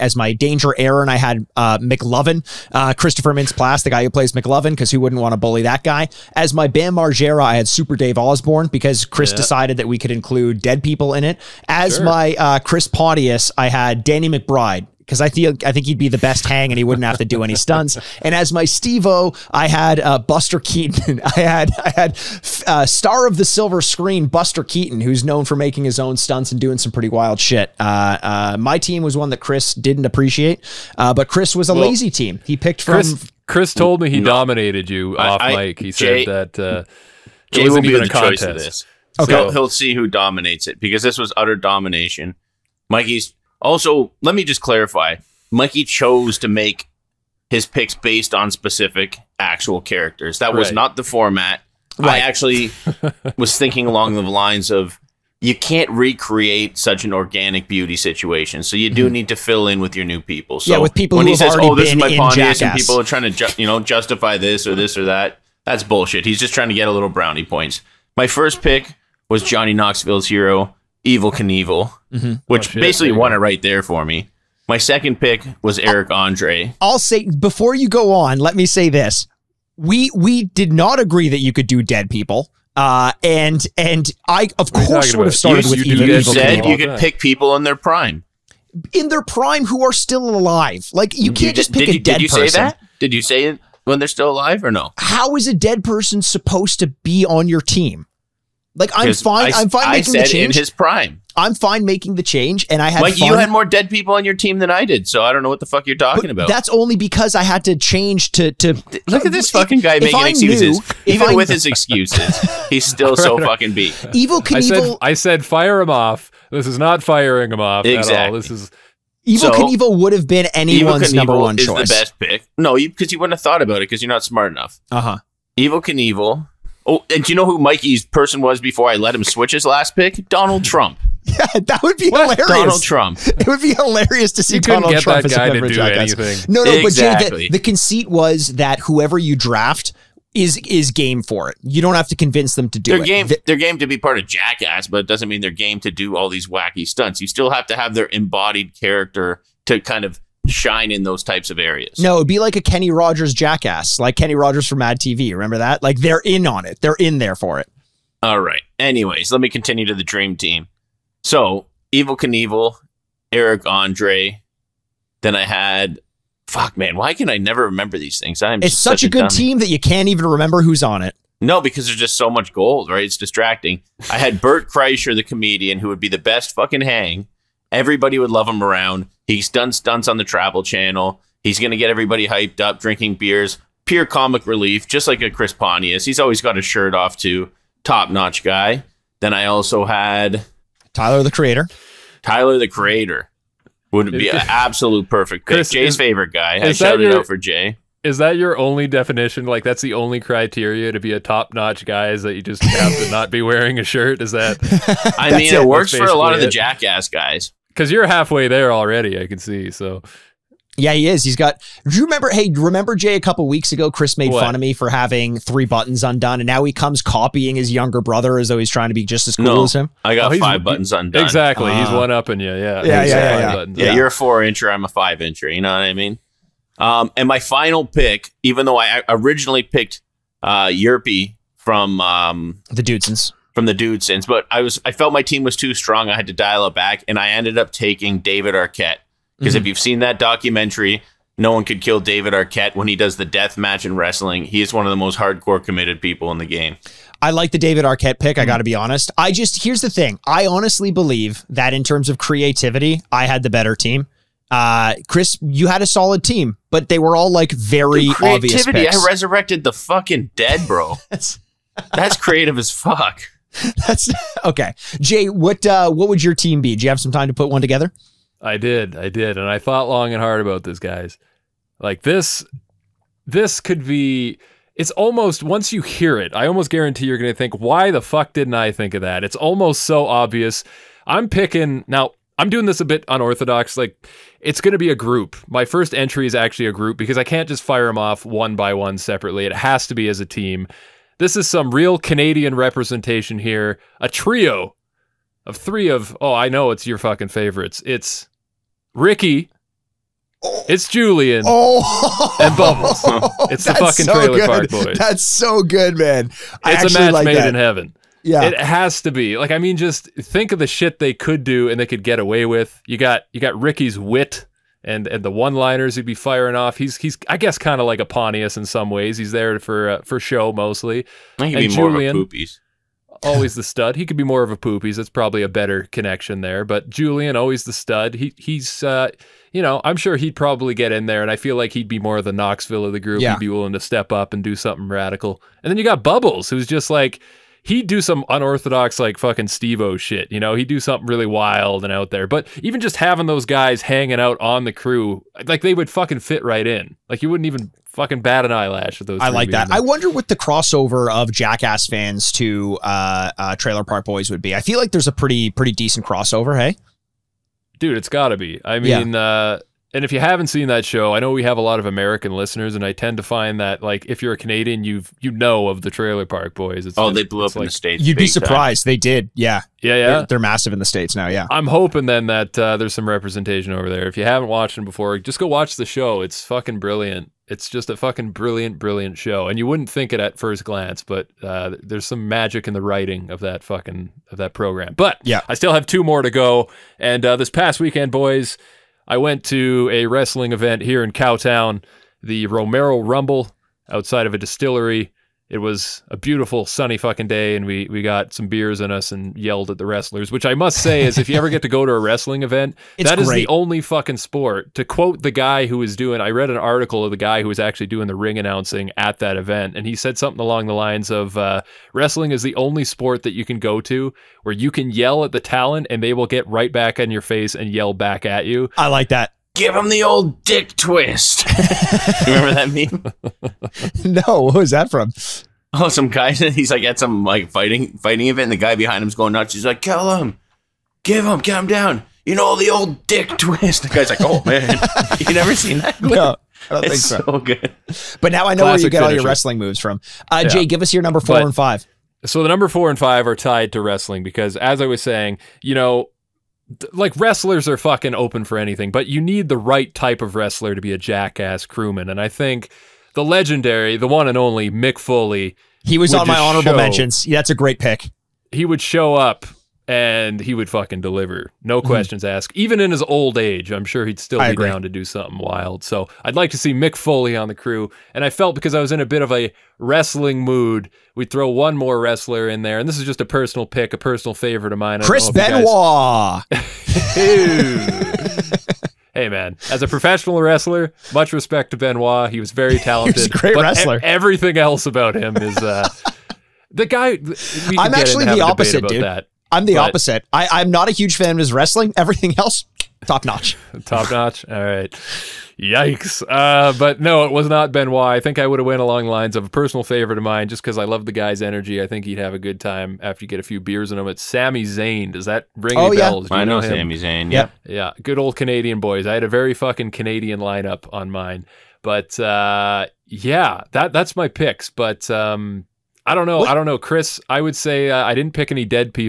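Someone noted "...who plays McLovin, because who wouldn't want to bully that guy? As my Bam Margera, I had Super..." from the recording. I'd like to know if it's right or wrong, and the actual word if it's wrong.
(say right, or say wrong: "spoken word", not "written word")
right.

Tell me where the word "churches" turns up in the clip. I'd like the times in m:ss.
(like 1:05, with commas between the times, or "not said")
not said.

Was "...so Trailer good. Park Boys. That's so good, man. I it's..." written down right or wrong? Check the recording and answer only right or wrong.
right.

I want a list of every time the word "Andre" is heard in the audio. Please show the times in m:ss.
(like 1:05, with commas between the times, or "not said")
1:16, 2:43.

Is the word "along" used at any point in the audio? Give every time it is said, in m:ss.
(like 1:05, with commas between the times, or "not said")
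0:53, 6:50, 8:18.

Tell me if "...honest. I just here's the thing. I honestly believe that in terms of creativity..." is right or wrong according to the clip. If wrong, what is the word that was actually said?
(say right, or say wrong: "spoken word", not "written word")
right.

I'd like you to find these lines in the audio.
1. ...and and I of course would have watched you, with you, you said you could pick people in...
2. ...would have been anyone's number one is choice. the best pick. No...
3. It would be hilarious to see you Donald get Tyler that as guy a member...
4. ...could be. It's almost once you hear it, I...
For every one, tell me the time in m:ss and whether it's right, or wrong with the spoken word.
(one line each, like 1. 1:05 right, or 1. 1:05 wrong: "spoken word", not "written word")
1. 1:23 wrong: "started", not "watched"
2. 2:00 right
3. 2:13 wrong: "Trump", not "Tyler"
4. 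4:33 right.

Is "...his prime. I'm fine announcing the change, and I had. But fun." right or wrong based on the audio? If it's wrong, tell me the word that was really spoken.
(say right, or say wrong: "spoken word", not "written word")
wrong: "making", not "announcing".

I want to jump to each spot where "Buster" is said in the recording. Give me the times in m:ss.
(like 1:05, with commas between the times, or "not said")
0:20, 0:24.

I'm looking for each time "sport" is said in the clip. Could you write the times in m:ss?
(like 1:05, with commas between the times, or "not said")
6:44, 6:52.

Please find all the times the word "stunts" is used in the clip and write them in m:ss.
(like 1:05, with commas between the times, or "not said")
0:17, 0:26, 2:26, 2:59.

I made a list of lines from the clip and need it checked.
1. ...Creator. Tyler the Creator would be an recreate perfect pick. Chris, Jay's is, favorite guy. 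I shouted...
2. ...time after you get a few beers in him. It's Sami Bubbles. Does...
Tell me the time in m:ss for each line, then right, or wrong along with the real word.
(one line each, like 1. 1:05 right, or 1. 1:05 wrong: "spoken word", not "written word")
1. 3:11 wrong: "absolute", not "recreate"
2. 8:22 wrong: "Zayn", not "Bubbles".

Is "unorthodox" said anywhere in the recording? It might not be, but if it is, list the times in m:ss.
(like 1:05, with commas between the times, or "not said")
4:43, 5:38.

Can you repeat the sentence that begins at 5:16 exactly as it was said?
He's he's I guess kind of like a Pontius in some ways.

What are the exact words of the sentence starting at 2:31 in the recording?
No, it'd be like a Kenny Rogers jackass, like Kenny Rogers from Mad TV.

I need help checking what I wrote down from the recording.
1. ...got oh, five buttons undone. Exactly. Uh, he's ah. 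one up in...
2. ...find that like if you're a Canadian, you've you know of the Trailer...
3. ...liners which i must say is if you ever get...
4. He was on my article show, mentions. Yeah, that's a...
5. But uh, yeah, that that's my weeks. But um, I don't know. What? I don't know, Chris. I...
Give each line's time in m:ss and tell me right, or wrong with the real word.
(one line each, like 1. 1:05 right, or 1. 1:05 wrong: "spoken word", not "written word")
1. 3:40 right
2. 6:03 right
3. 6:39 wrong: "wrestlers", not "liners"
4. 7:35 wrong: "honorable", not "article"
5. 8:31 wrong: "picks", not "weeks".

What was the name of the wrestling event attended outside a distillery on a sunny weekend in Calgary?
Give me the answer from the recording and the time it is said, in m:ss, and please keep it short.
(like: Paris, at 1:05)
Romero Rumble, at 6:32.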